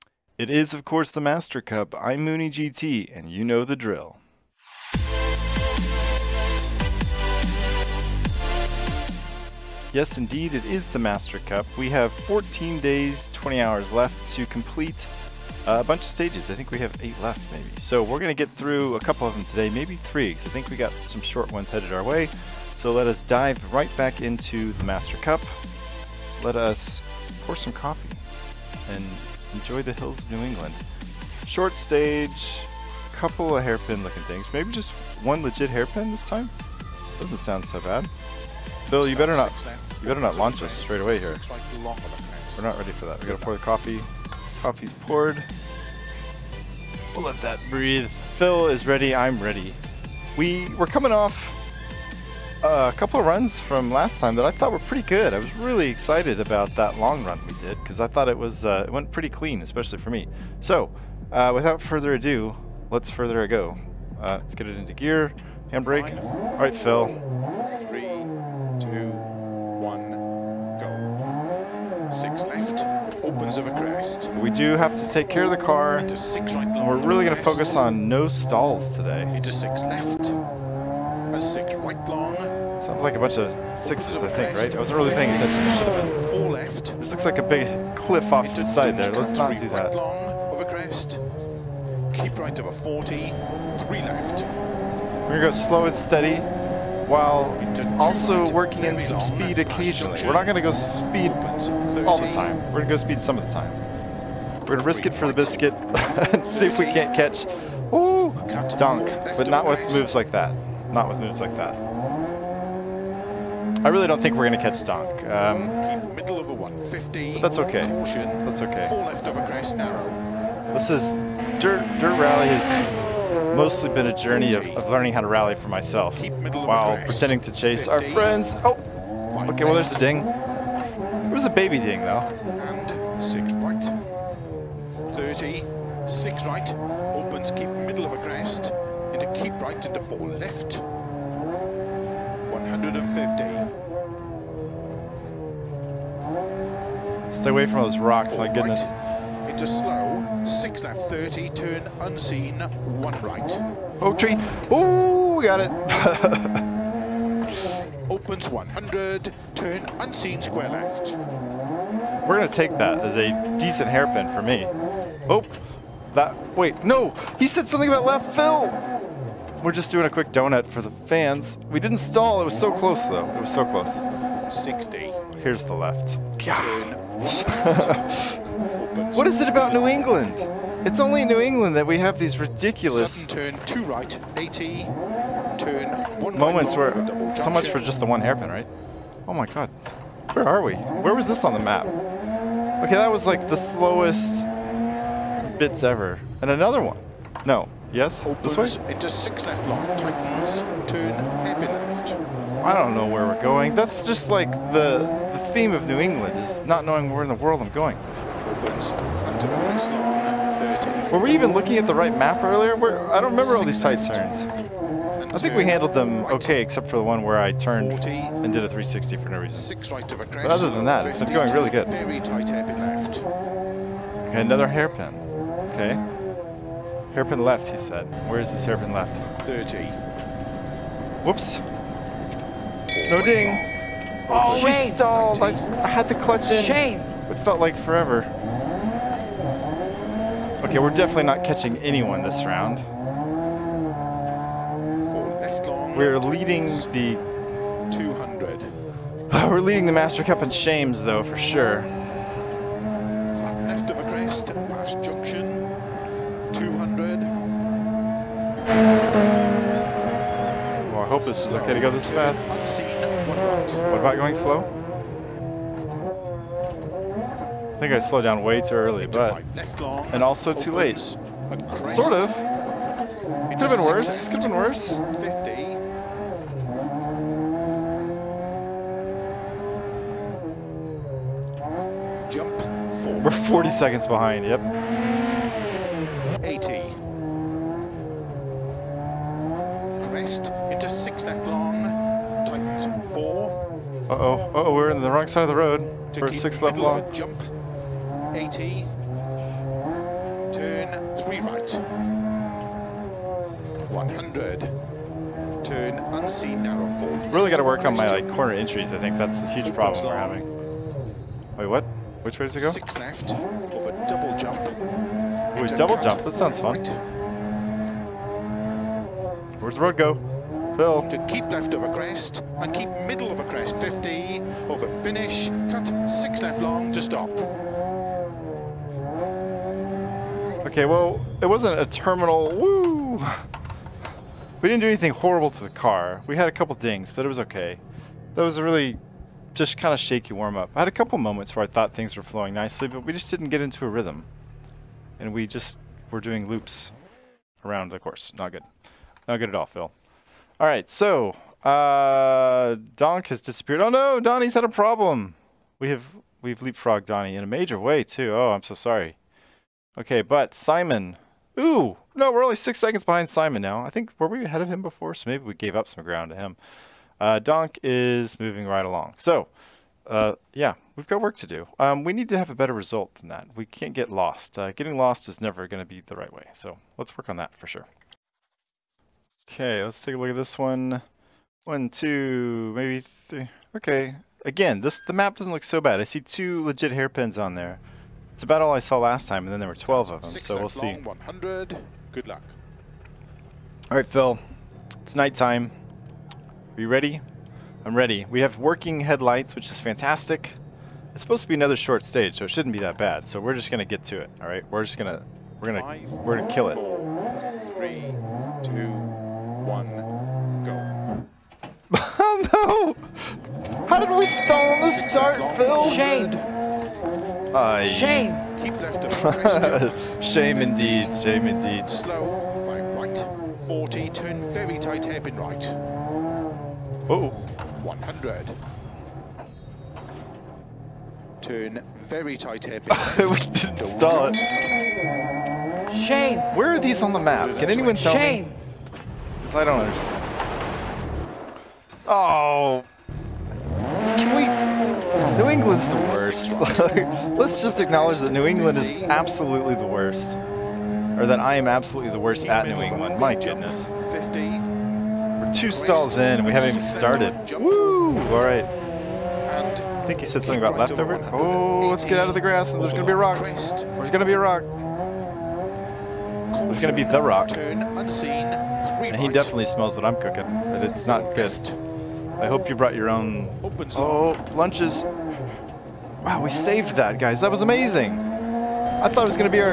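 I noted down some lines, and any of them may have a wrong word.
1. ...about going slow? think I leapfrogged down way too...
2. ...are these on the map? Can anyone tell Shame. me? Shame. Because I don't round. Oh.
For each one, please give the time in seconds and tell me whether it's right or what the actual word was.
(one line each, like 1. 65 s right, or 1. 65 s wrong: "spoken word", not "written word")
1. 263 s wrong: "slowed", not "leapfrogged"
2. 436 s wrong: "understand", not "round".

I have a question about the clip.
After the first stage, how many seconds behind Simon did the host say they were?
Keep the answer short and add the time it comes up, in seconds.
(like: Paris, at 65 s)
6, at 362 s.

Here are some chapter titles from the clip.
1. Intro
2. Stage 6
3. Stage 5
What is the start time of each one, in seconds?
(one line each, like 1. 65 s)
1. 8 s
2. 377 s
3. 36 s.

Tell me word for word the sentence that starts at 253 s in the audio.
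Flat left of a crest, past junction, 200.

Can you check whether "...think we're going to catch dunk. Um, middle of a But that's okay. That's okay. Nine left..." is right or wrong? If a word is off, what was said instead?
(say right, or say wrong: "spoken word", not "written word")
wrong: "Four", not "Nine".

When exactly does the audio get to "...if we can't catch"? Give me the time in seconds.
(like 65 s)
106 s.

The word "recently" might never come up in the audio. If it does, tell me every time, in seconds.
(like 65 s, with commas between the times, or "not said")
not said.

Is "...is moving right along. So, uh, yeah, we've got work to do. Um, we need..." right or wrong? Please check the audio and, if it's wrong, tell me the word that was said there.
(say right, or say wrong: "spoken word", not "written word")
right.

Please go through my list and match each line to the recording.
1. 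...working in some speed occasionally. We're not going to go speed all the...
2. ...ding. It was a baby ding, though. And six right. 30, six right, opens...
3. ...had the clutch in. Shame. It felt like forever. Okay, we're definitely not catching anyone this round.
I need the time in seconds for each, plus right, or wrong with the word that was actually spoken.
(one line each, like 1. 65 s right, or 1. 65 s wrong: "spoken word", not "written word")
1. 98 s right
2. 129 s right
3. 235 s right.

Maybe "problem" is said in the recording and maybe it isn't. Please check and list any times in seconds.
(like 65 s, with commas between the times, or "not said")
309 s, 354 s.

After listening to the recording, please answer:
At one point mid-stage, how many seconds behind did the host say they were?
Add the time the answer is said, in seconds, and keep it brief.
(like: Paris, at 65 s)
40, at 283 s.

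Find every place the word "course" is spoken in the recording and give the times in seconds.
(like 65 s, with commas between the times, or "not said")
0 s, 347 s.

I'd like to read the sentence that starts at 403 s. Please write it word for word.
So we're just gonna get to it.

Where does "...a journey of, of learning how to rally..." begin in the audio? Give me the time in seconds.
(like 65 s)
124 s.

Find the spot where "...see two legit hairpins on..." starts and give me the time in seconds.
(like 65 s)
386 s.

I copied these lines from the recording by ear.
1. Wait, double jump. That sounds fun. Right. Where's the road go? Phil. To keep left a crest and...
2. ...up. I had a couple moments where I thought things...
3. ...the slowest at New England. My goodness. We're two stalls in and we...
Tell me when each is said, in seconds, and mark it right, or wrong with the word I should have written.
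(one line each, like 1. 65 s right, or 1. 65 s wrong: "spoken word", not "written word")
1. 315 s right
2. 340 s right
3. 452 s wrong: "worst", not "slowest".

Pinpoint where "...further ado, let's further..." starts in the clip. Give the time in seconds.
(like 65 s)
61 s.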